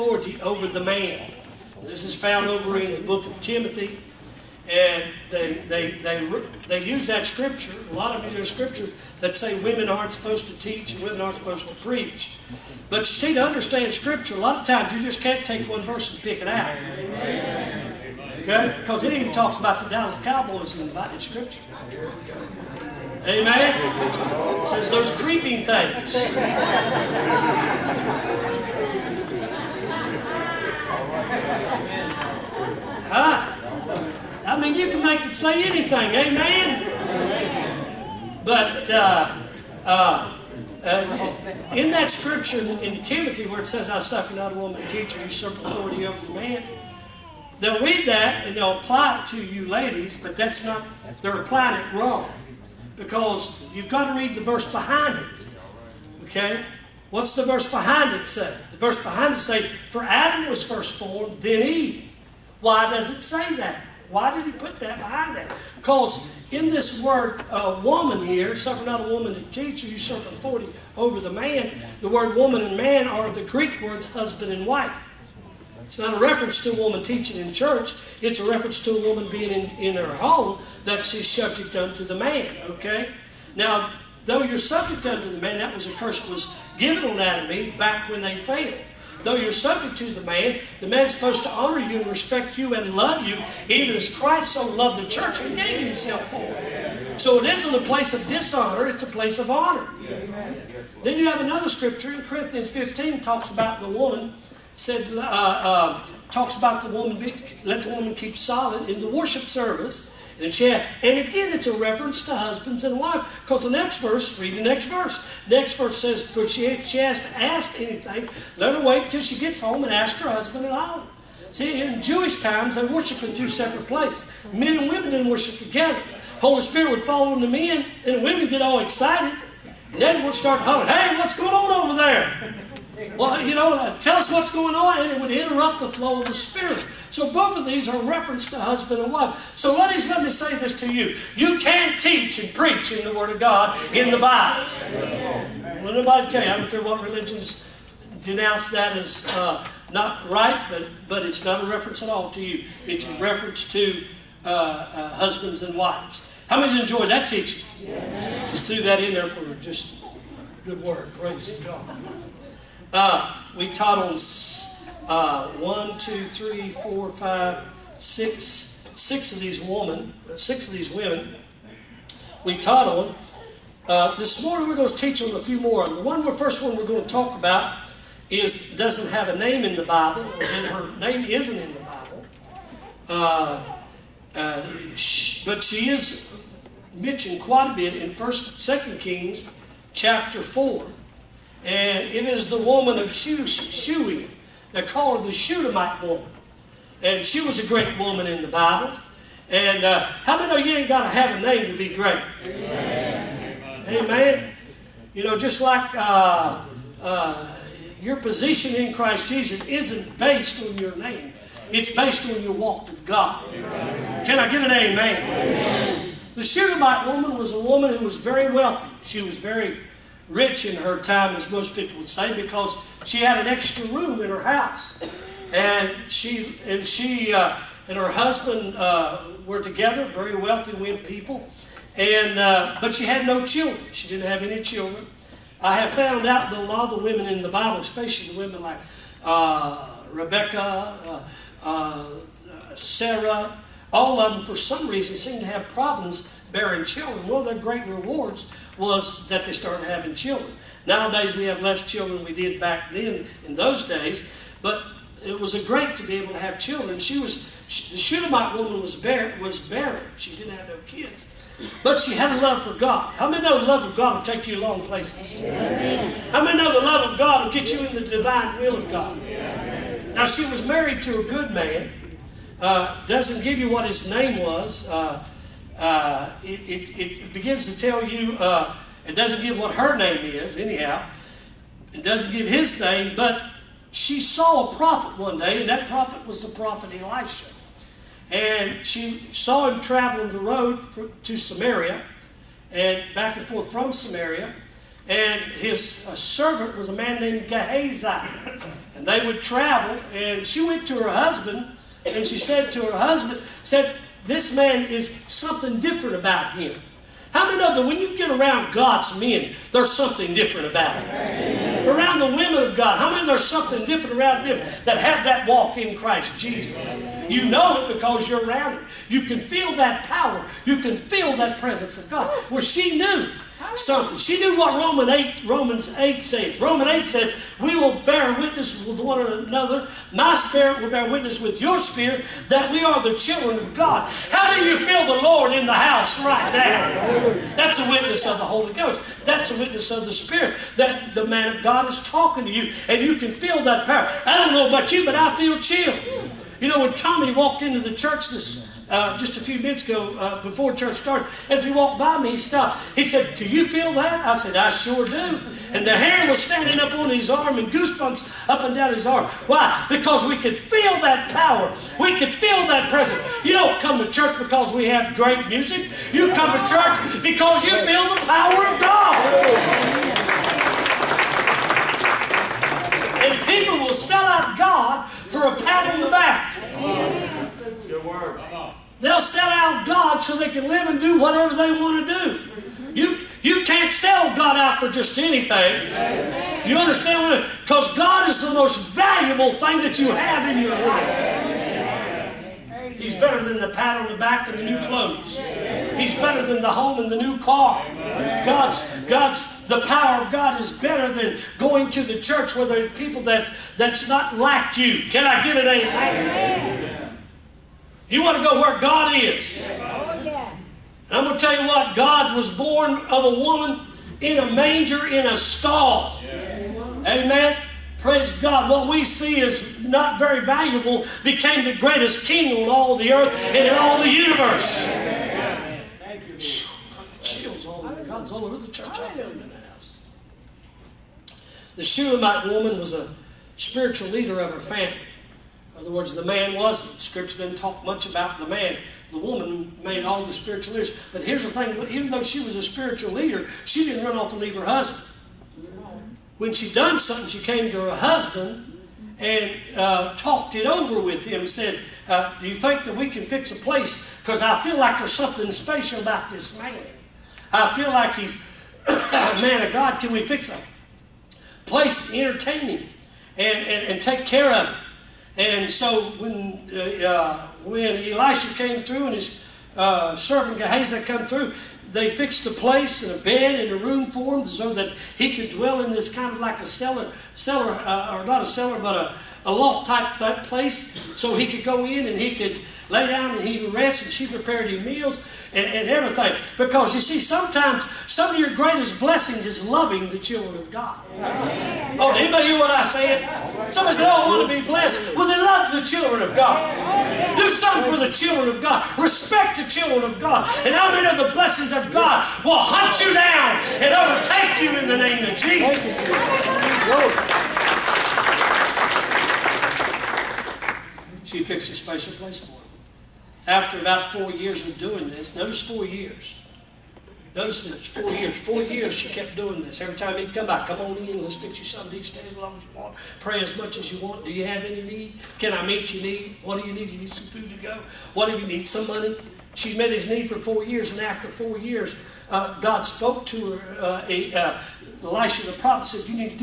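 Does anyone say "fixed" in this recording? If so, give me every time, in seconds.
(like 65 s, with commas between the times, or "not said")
472 s, 511 s.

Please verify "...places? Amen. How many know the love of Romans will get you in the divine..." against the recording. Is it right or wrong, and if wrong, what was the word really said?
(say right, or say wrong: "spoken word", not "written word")
wrong: "God", not "Romans".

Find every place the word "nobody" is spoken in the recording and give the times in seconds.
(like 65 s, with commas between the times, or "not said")
145 s.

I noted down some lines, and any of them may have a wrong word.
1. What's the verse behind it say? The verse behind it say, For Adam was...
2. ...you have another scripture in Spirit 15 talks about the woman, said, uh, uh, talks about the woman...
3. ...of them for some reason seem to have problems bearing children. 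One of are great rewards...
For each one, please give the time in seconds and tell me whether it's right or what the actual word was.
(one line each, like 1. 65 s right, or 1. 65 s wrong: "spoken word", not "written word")
1. 57 s right
2. 101 s wrong: "Corinthians", not "Spirit"
3. 244 s right.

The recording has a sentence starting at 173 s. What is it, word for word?
Uh, this morning we're going to teach on a few more.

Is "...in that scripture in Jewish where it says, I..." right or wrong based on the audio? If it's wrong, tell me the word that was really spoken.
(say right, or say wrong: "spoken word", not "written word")
wrong: "Timothy", not "Jewish".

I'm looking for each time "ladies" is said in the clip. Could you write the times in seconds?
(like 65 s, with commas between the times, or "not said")
49 s, 139 s.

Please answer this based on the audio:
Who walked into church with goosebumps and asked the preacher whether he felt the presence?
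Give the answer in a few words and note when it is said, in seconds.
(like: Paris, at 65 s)
Tommy, at 346 s.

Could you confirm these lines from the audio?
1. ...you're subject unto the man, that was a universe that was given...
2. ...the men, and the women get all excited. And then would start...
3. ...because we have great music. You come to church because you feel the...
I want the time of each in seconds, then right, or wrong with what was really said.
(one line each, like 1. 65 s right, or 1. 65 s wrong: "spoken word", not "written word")
1. 84 s wrong: "curse", not "universe"
2. 127 s right
3. 364 s right.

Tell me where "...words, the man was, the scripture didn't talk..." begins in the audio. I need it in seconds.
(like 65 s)
435 s.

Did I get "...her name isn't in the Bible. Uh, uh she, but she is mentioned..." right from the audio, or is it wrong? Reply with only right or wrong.
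right.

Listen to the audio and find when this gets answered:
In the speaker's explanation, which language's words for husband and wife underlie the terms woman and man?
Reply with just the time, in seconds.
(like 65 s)
73 s.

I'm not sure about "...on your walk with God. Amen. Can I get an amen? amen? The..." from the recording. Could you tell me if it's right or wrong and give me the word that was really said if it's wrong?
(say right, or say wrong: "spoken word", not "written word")
right.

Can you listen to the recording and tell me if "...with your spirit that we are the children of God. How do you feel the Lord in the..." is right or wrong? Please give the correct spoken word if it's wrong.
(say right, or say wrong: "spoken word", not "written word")
right.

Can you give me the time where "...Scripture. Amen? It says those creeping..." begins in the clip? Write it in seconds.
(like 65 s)
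21 s.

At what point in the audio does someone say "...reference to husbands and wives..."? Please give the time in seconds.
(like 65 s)
111 s.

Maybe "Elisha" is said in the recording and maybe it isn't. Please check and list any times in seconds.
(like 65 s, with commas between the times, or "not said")
287 s, 467 s, 535 s.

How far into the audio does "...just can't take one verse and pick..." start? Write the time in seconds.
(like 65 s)
15 s.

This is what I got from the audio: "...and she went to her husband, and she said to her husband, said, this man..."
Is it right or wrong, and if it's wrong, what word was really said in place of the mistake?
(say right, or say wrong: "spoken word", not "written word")
right.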